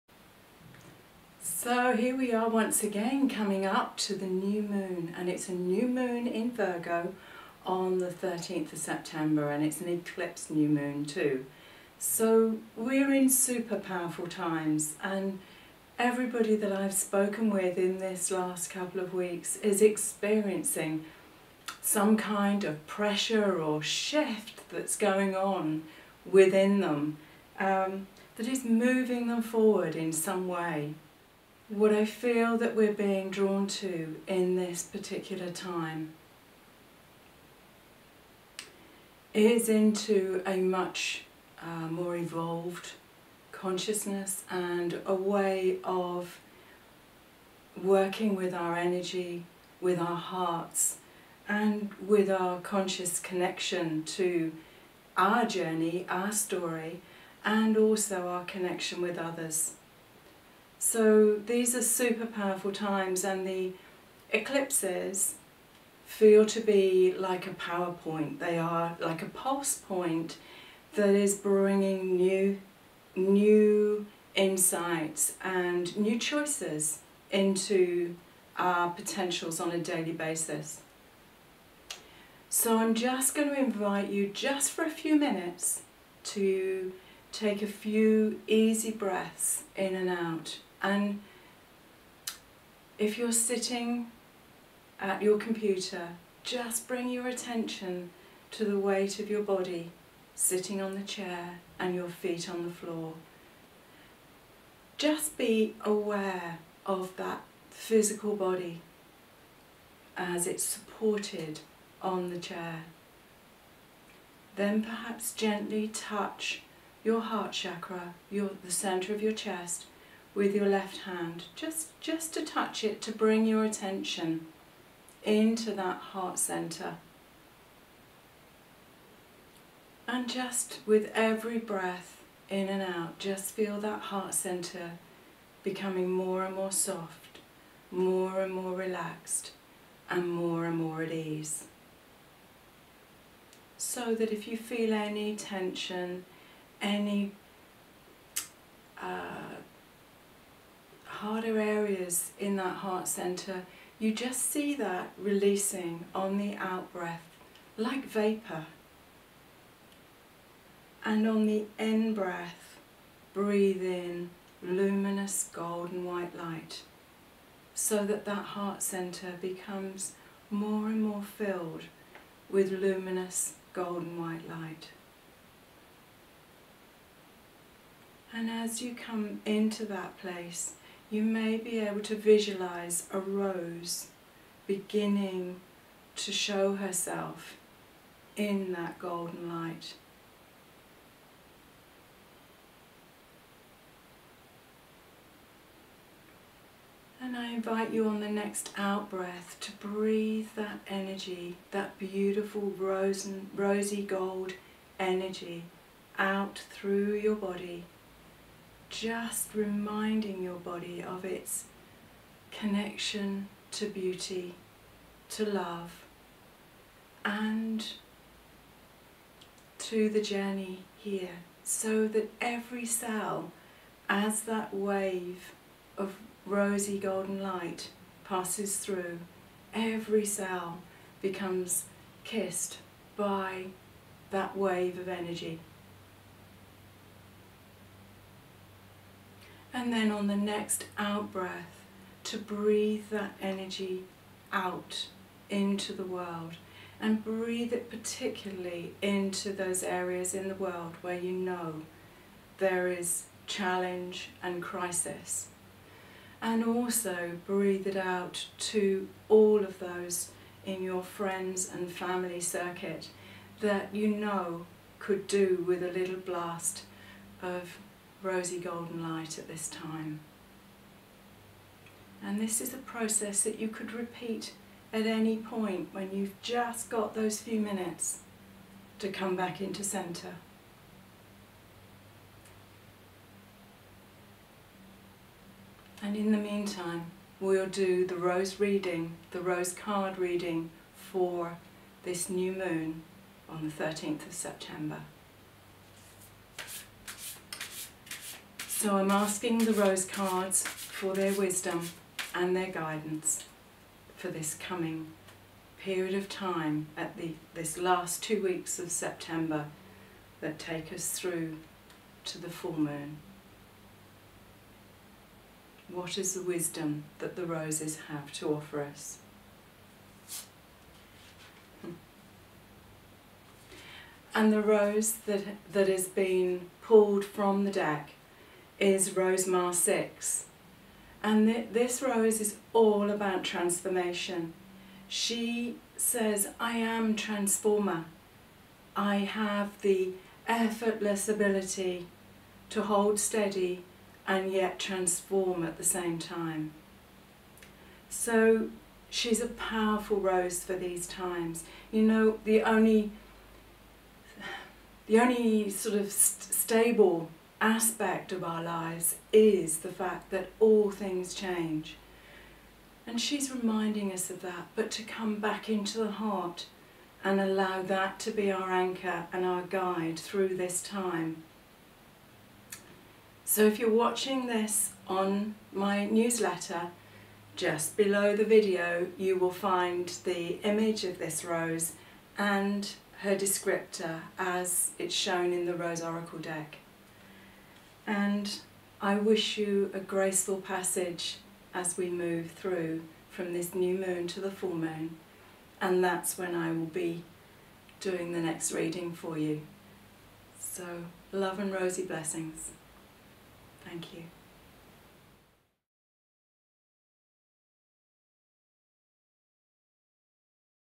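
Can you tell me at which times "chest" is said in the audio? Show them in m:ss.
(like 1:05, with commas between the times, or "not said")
1:59.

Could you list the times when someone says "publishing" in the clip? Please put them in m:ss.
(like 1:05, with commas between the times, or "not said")
not said.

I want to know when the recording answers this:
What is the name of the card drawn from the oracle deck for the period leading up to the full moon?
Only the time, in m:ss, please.
5:29.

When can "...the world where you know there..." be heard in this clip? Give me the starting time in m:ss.
4:10.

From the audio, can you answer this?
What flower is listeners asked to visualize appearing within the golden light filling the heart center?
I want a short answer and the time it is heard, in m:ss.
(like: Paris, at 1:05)
A rose, at 3:03.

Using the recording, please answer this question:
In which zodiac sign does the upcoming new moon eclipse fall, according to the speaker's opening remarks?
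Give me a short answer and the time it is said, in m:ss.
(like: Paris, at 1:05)
Virgo, at 0:06.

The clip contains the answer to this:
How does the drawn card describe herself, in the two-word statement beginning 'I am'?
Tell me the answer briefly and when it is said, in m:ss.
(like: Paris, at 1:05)
I am transformer, at 5:36.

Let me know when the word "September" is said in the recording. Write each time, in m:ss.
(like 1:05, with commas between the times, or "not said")
0:08, 4:54, 5:08.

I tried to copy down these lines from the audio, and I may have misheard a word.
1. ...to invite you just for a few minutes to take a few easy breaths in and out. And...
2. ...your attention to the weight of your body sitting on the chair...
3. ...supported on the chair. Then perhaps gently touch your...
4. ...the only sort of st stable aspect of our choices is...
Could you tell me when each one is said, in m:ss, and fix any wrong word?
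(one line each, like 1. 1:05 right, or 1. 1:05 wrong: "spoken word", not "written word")
1. 1:23 right
2. 1:37 right
3. 1:50 right
4. 5:55 wrong: "lives", not "choices".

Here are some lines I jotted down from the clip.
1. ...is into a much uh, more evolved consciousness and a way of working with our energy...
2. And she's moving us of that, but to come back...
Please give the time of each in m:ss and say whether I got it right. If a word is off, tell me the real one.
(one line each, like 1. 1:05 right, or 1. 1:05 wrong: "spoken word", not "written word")
1. 0:39 right
2. 6:03 wrong: "reminding", not "moving".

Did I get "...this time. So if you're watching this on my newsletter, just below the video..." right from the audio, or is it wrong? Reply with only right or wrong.
right.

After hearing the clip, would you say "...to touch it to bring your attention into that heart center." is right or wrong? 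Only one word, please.
right.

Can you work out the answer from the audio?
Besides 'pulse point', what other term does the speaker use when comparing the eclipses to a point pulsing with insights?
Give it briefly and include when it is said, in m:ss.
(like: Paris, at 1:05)
PowerPoint, at 1:07.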